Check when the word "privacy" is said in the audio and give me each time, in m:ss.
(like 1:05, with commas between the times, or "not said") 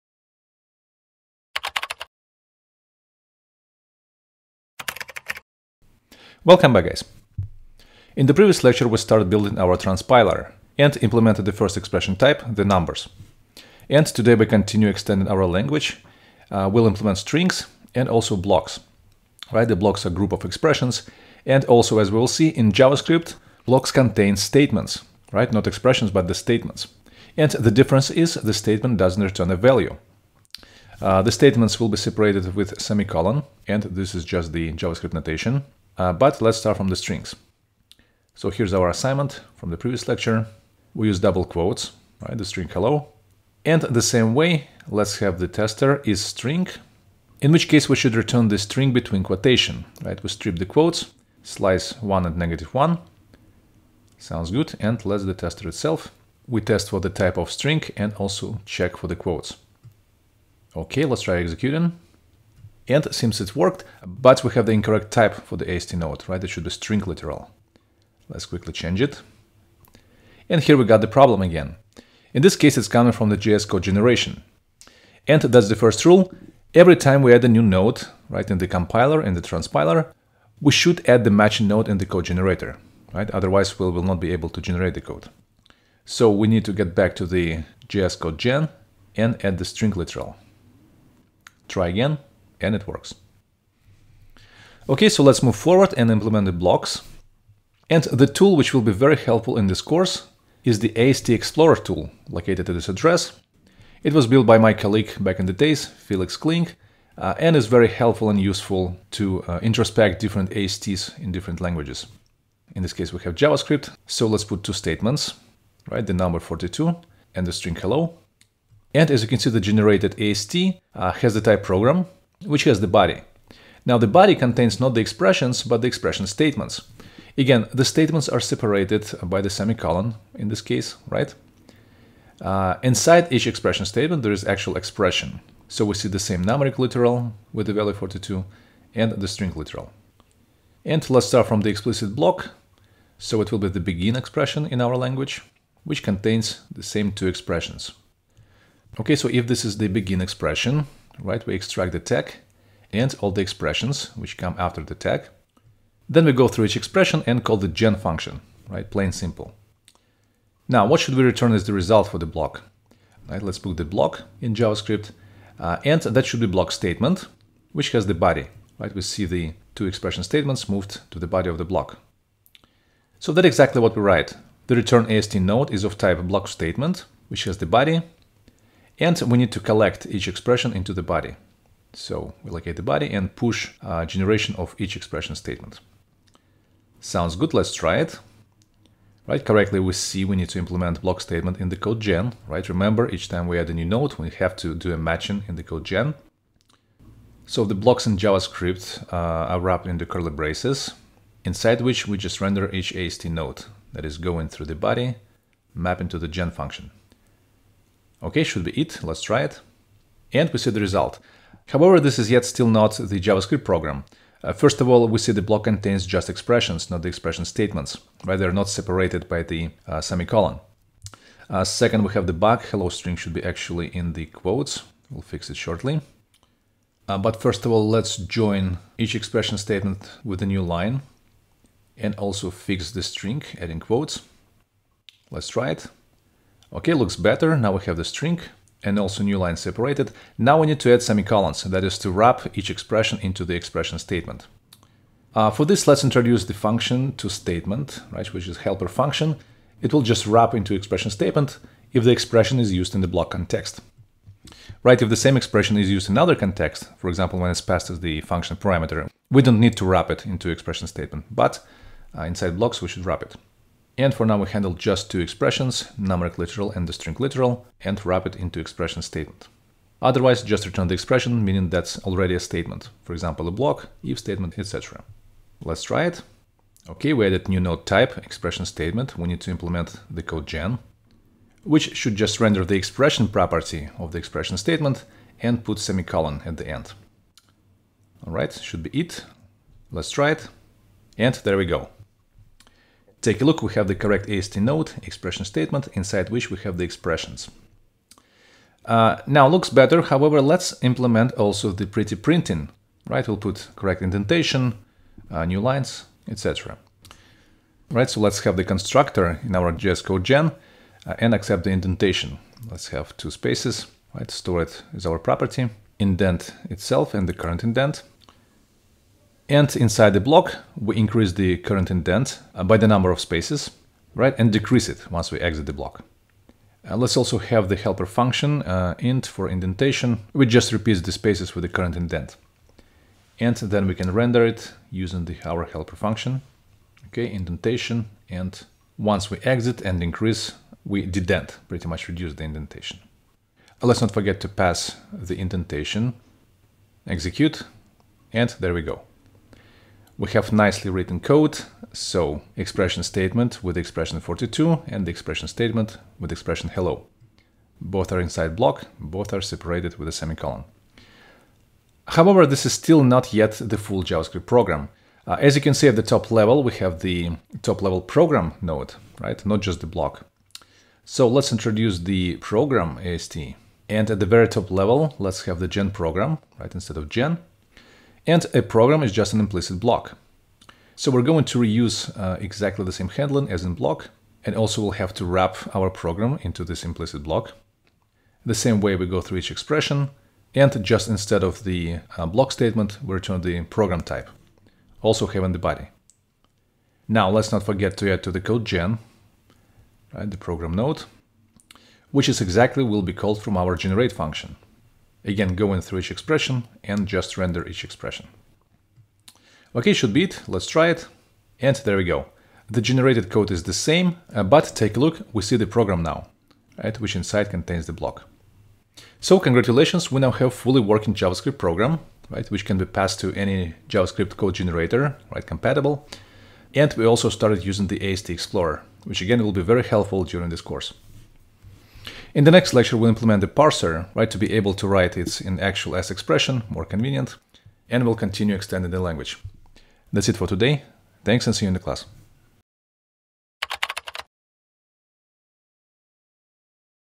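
not said.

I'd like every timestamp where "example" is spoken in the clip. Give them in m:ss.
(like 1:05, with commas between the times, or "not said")
4:17, 4:33.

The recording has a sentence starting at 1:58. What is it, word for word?
And as you can see, the generated AST uh, has the type program, which has the body.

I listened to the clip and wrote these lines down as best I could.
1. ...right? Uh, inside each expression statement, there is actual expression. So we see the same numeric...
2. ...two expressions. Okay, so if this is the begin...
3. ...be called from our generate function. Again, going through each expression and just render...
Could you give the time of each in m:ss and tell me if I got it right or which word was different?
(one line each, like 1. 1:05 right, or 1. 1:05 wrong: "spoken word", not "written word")
1. 2:11 right
2. 2:27 right
3. 6:43 right.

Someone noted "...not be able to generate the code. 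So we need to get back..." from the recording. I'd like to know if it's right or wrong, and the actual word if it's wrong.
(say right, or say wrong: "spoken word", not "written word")
right.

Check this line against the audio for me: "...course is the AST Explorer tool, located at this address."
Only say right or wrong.
right.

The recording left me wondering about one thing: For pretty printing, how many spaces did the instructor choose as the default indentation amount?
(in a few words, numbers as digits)
2.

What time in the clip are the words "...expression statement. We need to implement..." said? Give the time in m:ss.
4:38.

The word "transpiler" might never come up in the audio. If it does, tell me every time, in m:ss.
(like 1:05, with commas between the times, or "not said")
0:09, 1:19.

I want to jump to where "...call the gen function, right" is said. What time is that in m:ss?
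2:37.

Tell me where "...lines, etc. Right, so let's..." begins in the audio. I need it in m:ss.
5:05.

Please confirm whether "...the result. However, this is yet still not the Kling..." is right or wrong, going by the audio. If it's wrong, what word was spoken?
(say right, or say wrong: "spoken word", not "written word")
wrong: "JavaScript", not "Kling".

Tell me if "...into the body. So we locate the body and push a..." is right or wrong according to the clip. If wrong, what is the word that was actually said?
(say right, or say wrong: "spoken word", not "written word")
right.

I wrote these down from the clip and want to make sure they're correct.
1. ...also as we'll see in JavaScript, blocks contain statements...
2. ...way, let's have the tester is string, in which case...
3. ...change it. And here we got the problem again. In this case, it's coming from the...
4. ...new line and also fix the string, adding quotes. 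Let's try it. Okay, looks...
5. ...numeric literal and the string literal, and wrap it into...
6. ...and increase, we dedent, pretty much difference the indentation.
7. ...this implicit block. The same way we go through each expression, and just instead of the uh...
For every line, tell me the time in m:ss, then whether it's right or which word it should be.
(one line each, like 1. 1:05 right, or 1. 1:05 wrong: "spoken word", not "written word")
1. 0:21 right
2. 0:44 right
3. 1:08 right
4. 3:50 right
5. 4:25 right
6. 5:39 wrong: "reduce", not "difference"
7. 6:26 right.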